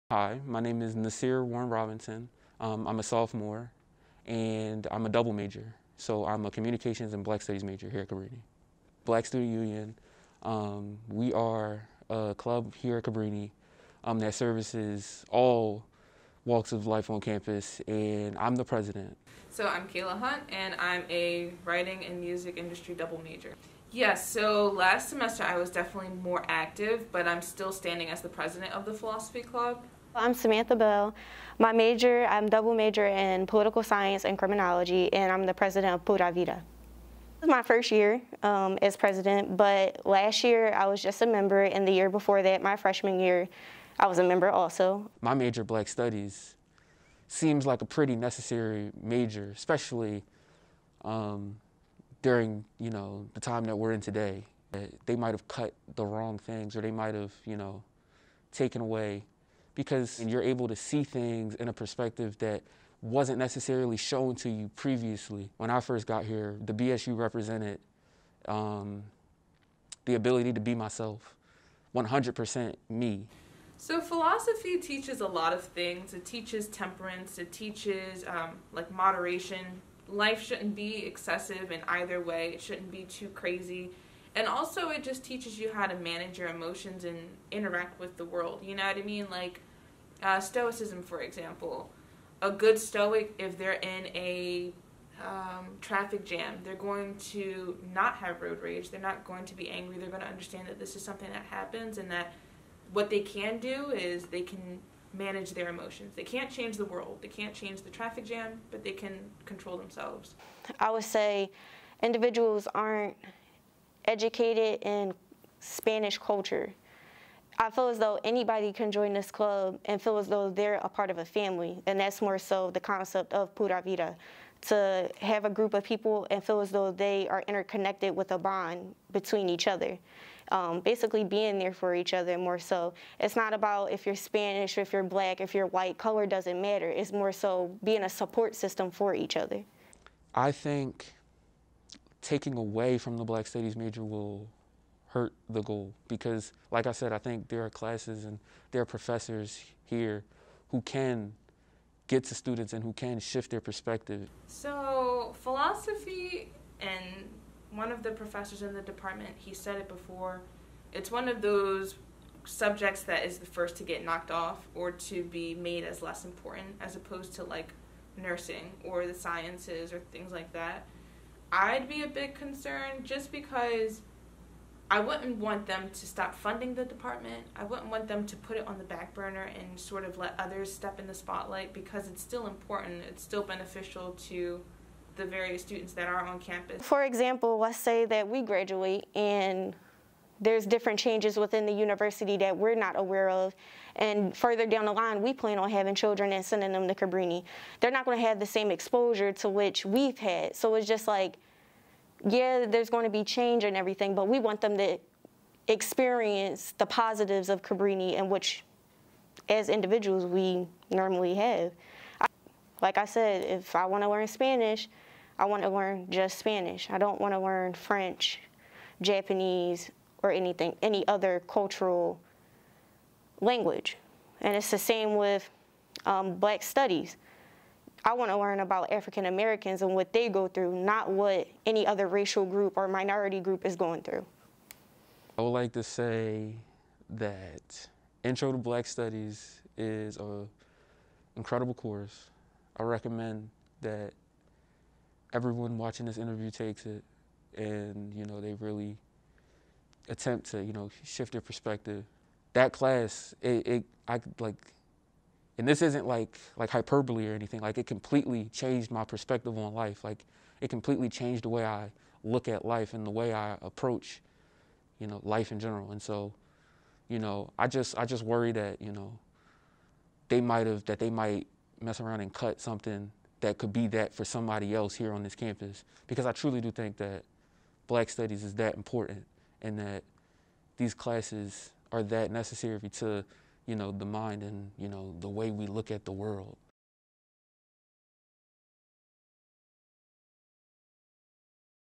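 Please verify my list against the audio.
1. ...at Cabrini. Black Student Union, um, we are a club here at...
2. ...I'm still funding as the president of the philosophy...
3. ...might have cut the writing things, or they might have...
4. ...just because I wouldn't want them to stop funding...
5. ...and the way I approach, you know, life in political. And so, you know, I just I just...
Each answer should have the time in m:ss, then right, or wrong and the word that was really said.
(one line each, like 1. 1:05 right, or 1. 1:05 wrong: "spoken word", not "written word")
1. 0:08 right
2. 0:27 wrong: "standing", not "funding"
3. 0:55 wrong: "wrong", not "writing"
4. 2:53 right
5. 4:22 wrong: "general", not "political".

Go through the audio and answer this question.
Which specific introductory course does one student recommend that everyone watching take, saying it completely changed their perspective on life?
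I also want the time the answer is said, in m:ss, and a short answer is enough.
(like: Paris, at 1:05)
Intro to Black Studies, at 3:58.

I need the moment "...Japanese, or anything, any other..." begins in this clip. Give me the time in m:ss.
3:39.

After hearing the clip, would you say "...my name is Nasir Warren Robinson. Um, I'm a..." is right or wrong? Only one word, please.
right.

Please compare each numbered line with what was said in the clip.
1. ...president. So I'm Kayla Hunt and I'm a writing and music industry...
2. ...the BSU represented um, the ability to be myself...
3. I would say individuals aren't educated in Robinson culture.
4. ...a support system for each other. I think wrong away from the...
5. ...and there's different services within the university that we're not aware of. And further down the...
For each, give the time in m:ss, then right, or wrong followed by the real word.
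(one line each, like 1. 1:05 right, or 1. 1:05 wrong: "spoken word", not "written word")
1. 0:18 right
2. 1:06 right
3. 1:50 wrong: "Spanish", not "Robinson"
4. 2:18 wrong: "taking", not "wrong"
5. 3:09 wrong: "changes", not "services".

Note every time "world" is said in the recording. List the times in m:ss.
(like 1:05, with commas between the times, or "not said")
1:28, 1:46, 4:46.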